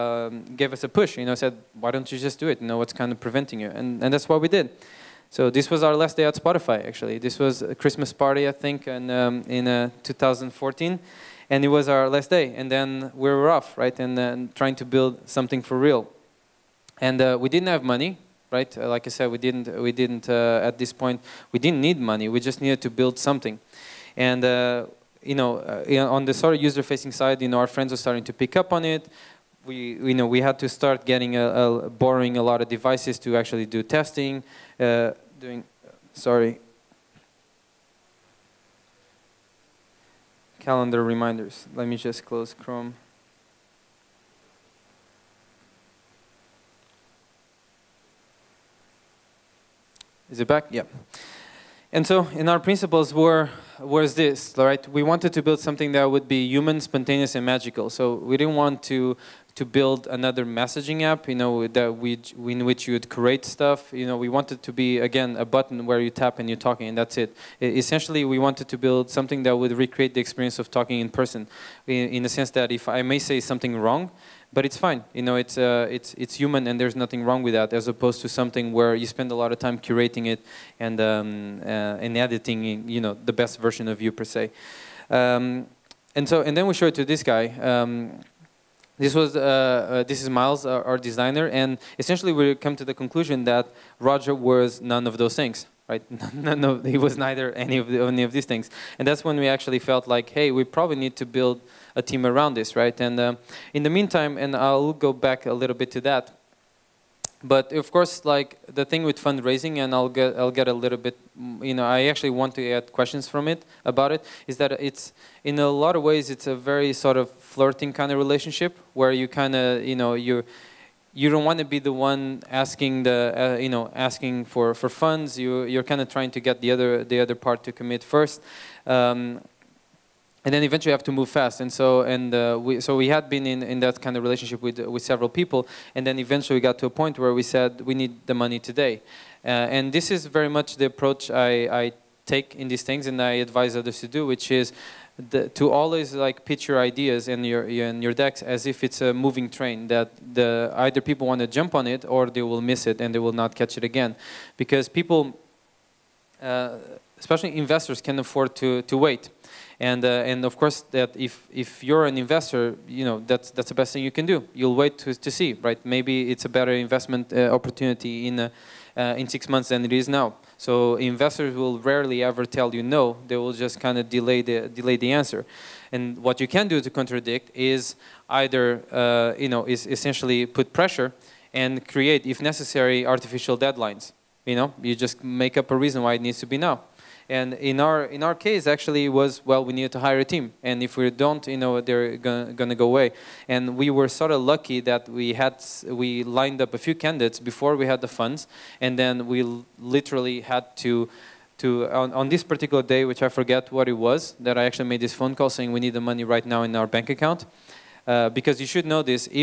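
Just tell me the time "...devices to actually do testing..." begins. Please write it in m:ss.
0:32.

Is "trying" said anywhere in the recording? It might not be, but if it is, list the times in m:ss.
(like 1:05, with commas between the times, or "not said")
0:14, 2:06.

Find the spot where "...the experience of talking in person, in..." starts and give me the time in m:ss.
1:10.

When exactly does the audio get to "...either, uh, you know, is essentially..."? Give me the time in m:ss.
2:58.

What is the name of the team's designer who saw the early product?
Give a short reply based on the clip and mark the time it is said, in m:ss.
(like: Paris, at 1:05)
Miles, at 1:30.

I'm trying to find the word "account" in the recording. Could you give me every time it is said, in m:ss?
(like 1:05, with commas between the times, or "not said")
3:27.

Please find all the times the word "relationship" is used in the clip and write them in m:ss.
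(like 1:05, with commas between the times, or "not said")
1:58, 2:14.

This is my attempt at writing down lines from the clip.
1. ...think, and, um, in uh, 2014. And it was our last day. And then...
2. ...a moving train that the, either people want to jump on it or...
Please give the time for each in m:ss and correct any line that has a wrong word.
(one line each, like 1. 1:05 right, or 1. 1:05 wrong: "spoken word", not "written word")
1. 0:08 right
2. 2:29 right.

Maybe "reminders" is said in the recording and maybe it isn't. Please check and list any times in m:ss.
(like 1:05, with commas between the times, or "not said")
0:41.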